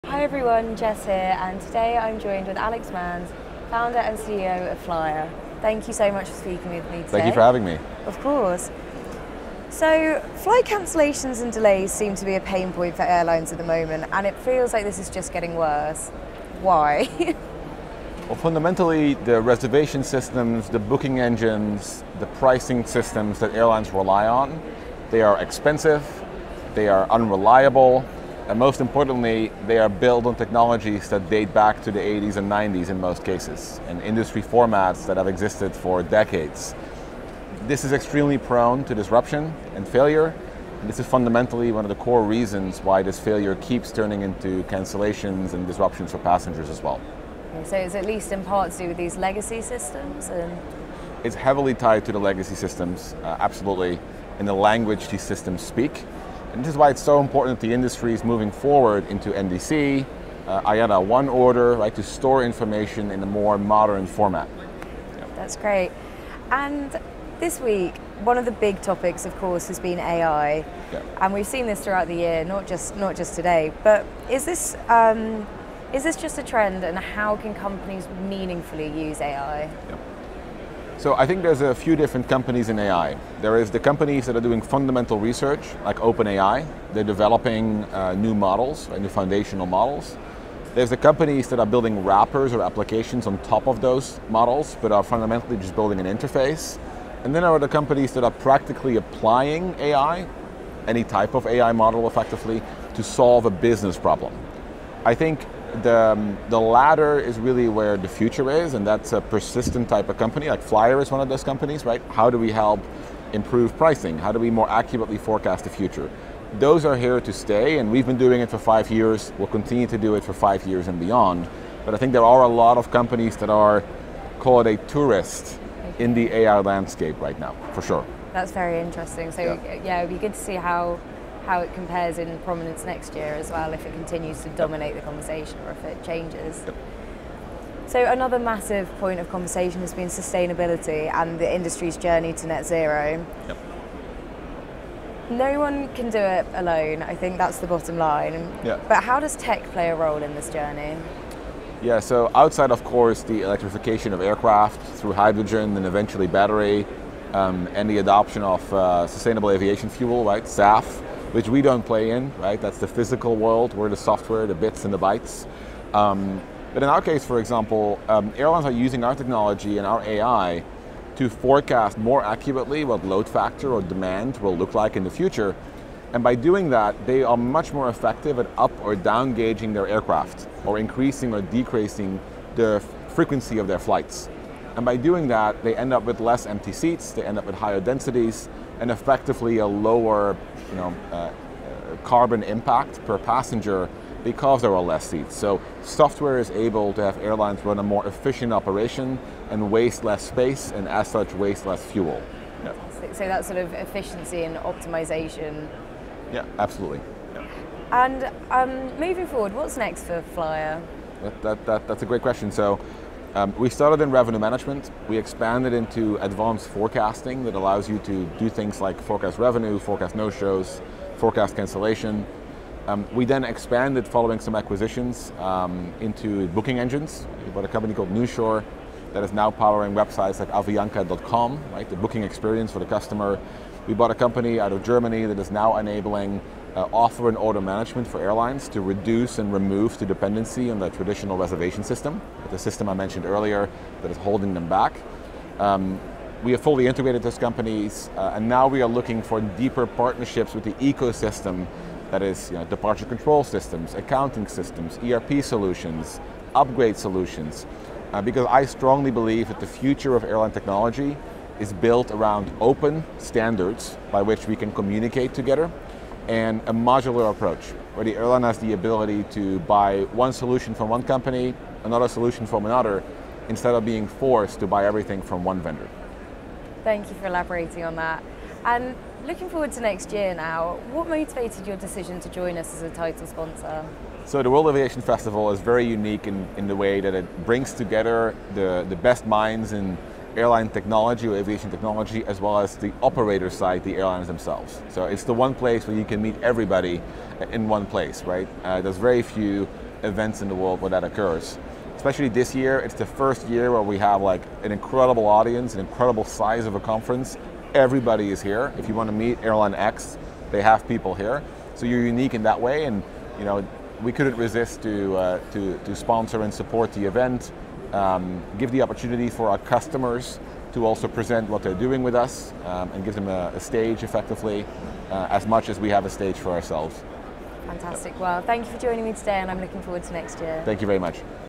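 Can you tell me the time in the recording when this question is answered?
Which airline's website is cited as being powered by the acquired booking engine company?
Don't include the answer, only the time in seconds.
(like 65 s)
230 s.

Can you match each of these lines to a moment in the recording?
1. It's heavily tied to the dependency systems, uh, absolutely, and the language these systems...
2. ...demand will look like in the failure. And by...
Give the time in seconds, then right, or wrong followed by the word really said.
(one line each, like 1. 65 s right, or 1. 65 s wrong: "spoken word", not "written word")
1. 51 s wrong: "legacy", not "dependency"
2. 173 s wrong: "future", not "failure".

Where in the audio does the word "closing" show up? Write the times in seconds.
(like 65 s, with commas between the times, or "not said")
not said.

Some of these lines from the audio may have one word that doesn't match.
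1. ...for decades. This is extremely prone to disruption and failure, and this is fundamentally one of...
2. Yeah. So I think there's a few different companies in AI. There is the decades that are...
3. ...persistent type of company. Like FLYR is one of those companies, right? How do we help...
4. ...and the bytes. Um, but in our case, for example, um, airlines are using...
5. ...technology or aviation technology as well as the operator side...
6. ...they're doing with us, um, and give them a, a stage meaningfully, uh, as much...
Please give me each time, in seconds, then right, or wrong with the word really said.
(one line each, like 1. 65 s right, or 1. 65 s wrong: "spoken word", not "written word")
1. 35 s right
2. 79 s wrong: "companies", not "decades"
3. 109 s right
4. 164 s right
5. 290 s right
6. 321 s wrong: "effectively", not "meaningfully".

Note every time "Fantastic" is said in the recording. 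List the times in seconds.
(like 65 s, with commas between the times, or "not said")
327 s.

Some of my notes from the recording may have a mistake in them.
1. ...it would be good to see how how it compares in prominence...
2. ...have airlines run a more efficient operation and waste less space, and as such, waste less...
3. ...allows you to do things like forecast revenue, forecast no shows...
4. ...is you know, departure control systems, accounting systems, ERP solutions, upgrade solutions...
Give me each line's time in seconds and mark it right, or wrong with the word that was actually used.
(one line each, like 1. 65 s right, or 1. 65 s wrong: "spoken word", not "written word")
1. 130 s right
2. 197 s right
3. 217 s right
4. 252 s right.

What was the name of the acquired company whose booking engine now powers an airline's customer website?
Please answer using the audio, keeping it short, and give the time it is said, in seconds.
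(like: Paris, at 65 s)
Newshore, at 228 s.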